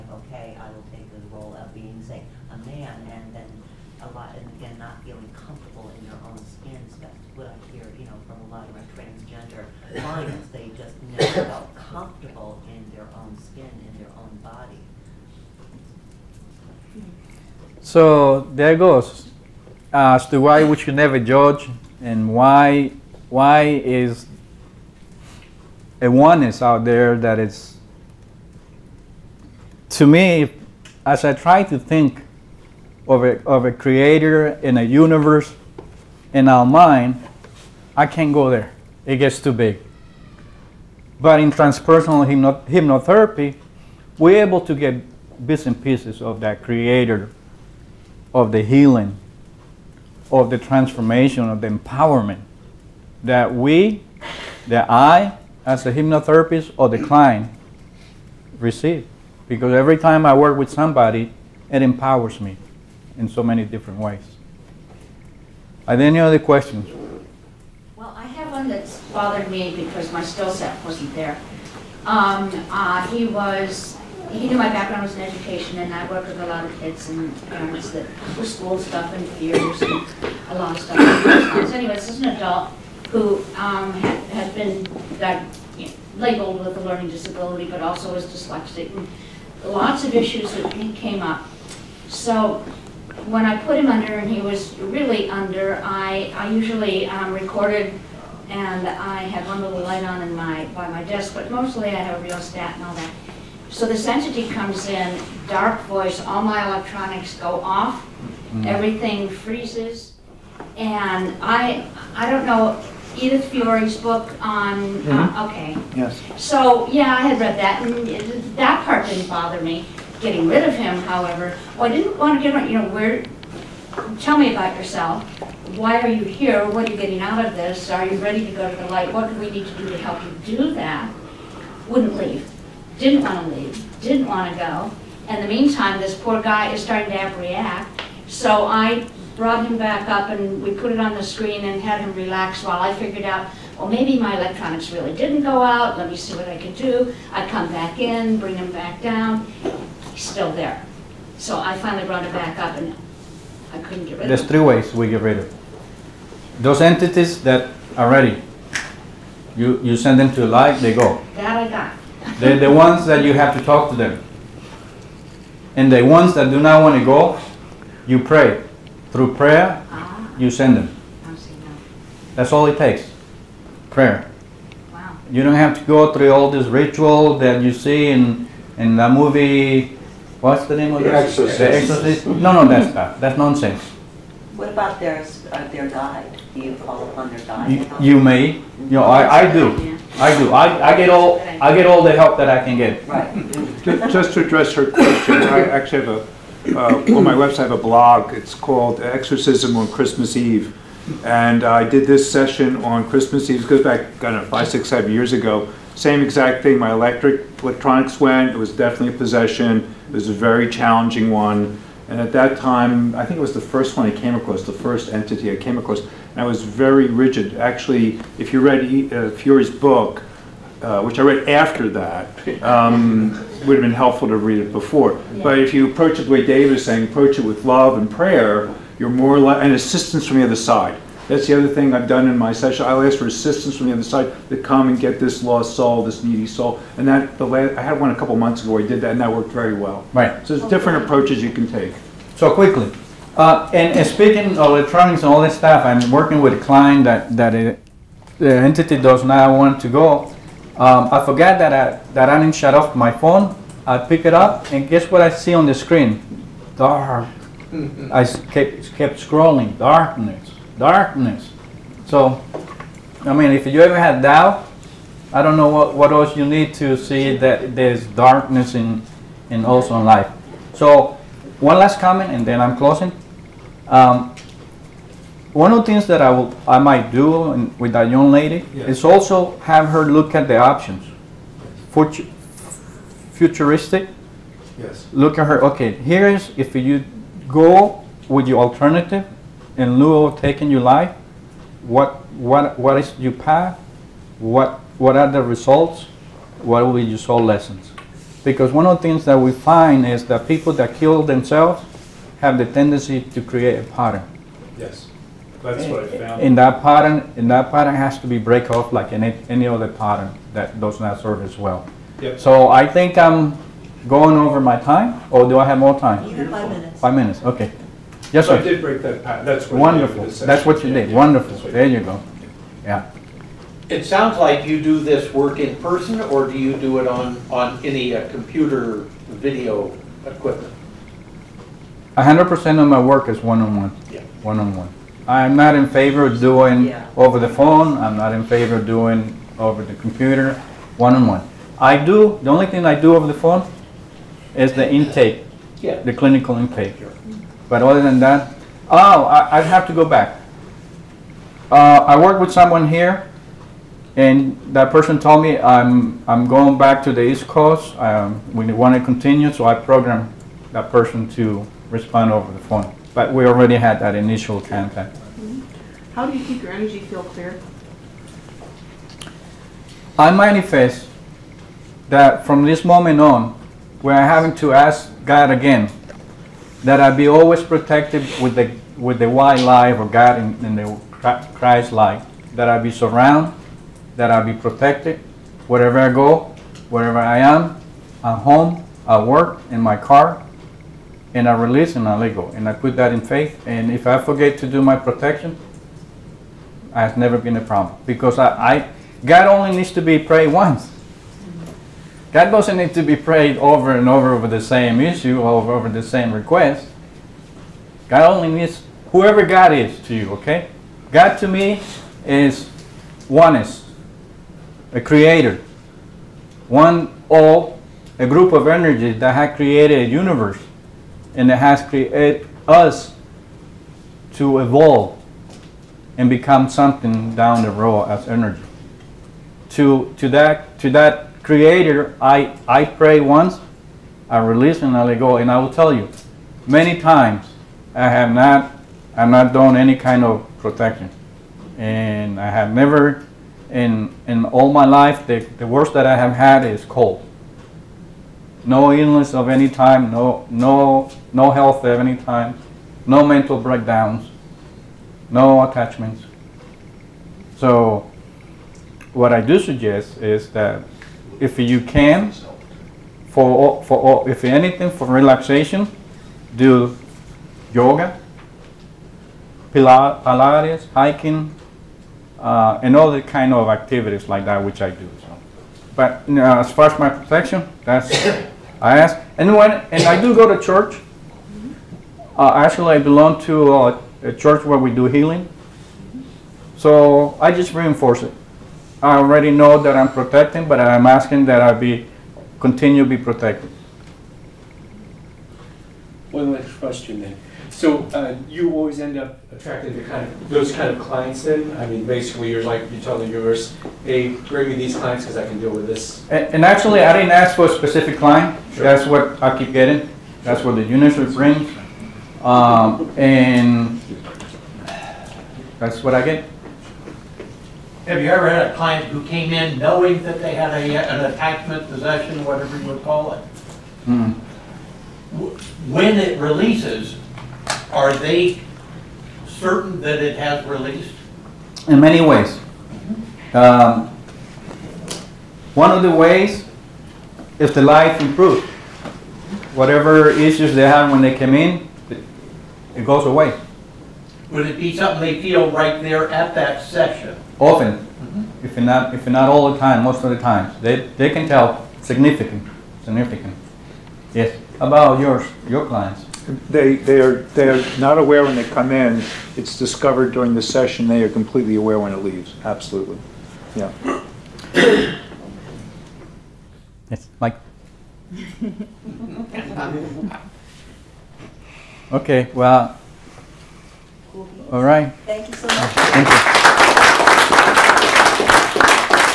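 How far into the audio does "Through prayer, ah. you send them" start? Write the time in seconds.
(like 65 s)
169 s.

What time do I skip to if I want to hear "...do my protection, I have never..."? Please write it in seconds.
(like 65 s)
394 s.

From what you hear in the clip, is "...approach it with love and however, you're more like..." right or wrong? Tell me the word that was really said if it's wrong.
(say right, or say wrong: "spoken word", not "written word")
wrong: "prayer", not "however".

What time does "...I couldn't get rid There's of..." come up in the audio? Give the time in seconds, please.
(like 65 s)
153 s.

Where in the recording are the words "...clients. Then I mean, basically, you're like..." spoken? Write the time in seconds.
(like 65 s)
501 s.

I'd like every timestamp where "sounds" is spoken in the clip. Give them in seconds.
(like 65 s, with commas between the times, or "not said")
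324 s.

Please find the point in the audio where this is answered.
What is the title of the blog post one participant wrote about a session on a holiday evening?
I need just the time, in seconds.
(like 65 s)
198 s.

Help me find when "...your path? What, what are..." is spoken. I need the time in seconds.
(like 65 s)
293 s.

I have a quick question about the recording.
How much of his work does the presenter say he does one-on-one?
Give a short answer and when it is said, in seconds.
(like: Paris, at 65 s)
100 percent, at 332 s.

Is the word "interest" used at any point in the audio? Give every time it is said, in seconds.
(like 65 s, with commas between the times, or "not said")
not said.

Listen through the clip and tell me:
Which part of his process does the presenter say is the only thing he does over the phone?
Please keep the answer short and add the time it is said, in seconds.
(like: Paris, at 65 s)
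The clinical intake, at 346 s.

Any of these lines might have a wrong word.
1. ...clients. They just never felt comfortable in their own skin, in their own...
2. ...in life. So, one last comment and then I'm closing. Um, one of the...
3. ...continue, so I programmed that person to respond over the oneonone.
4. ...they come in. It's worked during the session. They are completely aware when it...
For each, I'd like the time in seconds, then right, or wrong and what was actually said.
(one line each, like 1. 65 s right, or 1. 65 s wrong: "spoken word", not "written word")
1. 10 s right
2. 269 s right
3. 359 s wrong: "phone", not "oneonone"
4. 558 s wrong: "discovered", not "worked".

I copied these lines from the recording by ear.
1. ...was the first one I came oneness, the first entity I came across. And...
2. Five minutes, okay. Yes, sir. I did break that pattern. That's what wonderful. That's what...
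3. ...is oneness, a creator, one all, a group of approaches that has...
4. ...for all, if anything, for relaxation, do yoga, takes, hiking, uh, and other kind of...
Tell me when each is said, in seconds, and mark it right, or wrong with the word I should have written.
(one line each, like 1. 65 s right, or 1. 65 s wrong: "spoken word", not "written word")
1. 213 s wrong: "across", not "oneness"
2. 316 s right
3. 412 s wrong: "energies", not "approaches"
4. 463 s wrong: "pilates", not "takes".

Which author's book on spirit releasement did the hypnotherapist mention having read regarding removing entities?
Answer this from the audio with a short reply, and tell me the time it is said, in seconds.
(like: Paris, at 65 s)
Edith Fiore, at 113 s.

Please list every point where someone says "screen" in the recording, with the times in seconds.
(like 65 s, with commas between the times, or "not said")
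141 s, 255 s.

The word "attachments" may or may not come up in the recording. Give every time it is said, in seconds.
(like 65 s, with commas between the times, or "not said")
455 s, 521 s.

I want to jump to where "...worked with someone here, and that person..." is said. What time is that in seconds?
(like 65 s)
352 s.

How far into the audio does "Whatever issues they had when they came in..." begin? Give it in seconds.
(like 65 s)
539 s.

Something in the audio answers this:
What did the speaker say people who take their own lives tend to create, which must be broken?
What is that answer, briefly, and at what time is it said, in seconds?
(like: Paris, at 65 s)
A pattern, at 303 s.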